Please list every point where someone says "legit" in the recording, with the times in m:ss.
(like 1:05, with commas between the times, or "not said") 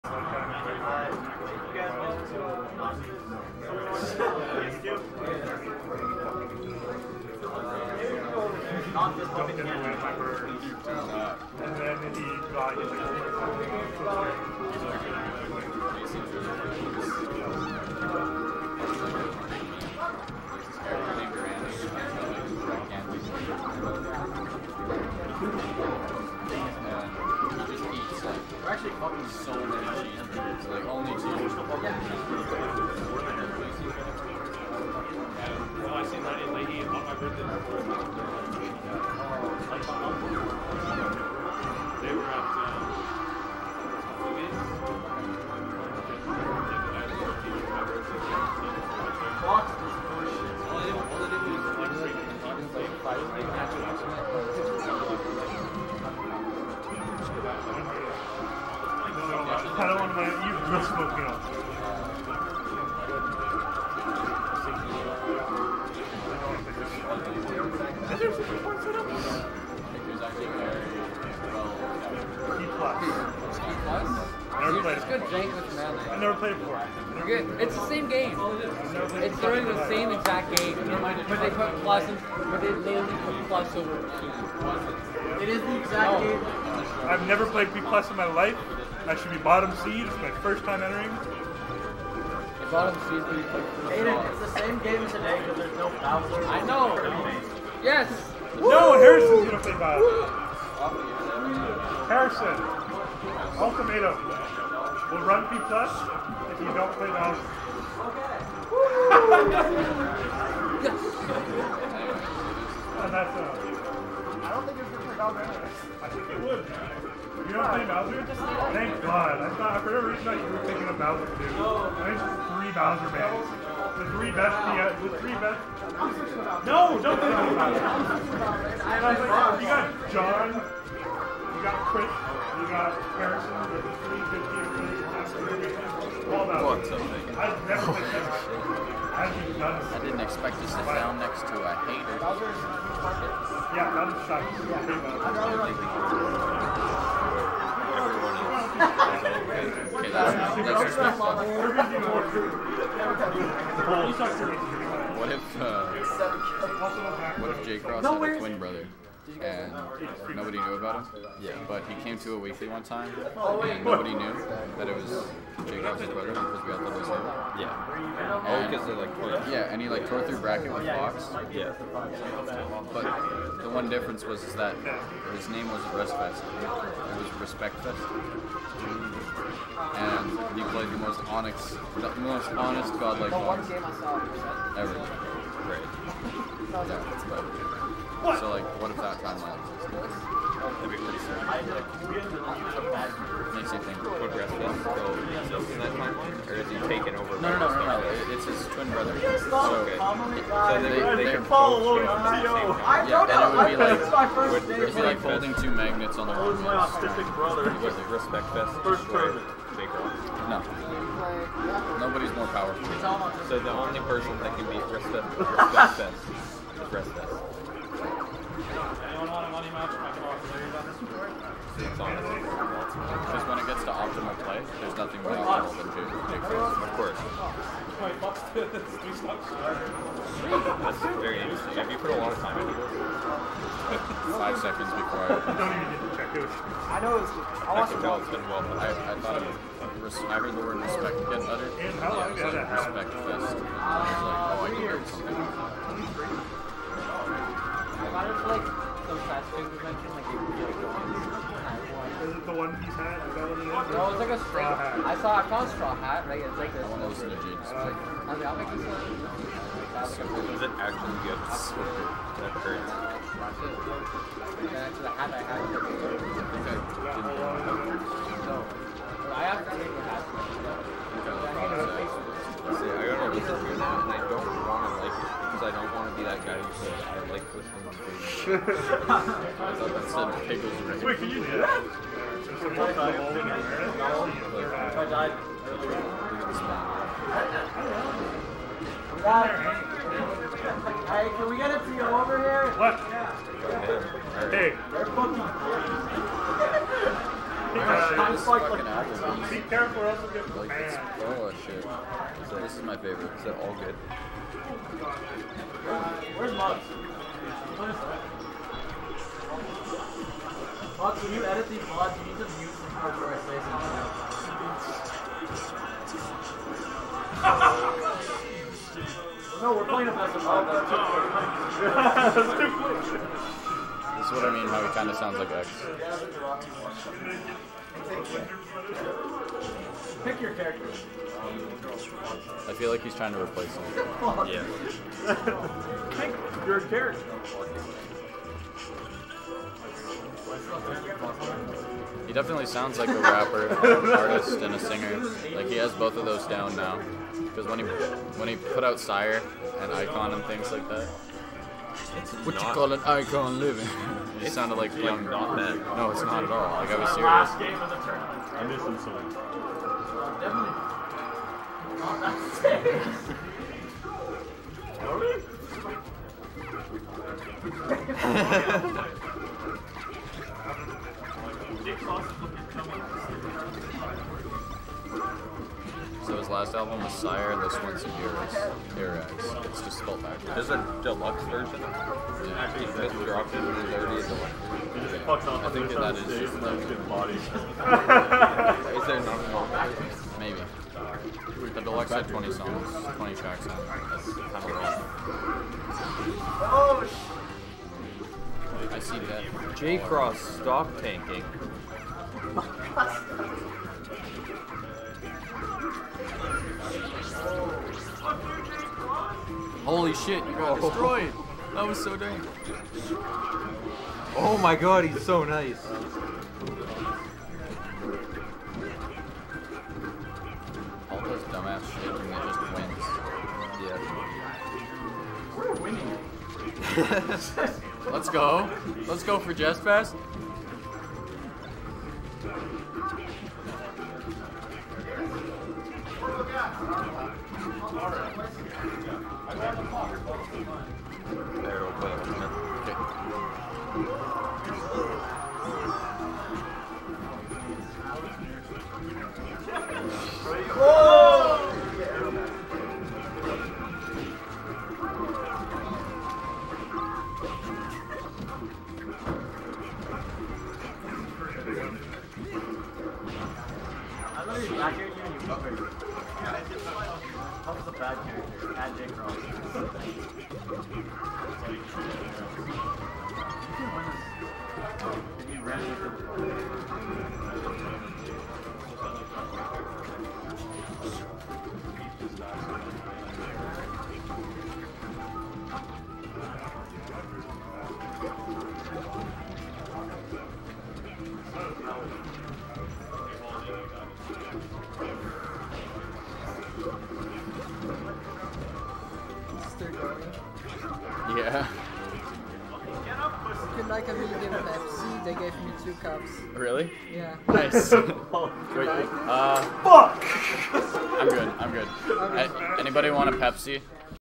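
4:17.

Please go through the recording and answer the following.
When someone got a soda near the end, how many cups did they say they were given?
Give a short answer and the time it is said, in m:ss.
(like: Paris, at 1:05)
2 cups, at 8:25.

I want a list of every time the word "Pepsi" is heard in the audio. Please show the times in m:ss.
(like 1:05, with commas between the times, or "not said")
8:23, 8:33.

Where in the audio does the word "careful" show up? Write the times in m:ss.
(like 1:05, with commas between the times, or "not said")
4:59.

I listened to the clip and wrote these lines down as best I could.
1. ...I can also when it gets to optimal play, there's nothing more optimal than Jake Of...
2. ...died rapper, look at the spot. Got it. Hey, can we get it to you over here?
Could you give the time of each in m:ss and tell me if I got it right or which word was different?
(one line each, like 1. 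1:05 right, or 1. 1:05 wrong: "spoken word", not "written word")
1. 3:39 right
2. 4:45 wrong: "earlier", not "rapper".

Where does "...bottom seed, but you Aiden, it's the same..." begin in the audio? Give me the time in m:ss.
1:32.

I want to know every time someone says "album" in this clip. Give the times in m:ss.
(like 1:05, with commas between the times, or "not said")
6:16, 6:29.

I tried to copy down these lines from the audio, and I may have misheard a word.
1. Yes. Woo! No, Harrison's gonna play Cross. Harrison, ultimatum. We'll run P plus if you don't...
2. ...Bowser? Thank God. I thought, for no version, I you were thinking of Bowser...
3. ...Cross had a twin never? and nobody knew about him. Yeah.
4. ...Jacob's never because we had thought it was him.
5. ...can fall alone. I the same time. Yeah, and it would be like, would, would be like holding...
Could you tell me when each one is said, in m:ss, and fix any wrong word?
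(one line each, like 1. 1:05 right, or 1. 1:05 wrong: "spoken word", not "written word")
1. 1:37 wrong: "Bowser", not "Cross"
2. 1:57 wrong: "reason", not "version"
3. 2:37 wrong: "brother", not "never"
4. 2:45 wrong: "brother", not "never"
5. 3:21 right.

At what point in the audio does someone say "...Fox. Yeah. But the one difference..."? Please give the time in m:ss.
2:50.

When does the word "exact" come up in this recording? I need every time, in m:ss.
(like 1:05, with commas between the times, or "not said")
1:20, 1:25.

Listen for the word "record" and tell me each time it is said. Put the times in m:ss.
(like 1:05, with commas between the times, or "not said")
not said.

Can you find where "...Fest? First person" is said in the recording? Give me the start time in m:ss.
3:28.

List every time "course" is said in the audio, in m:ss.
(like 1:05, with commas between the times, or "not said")
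3:46.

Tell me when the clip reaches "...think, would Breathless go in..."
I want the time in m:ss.
3:13.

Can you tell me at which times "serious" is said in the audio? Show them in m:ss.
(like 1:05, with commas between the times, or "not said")
5:57, 6:12.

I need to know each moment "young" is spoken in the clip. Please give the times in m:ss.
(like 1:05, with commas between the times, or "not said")
5:54.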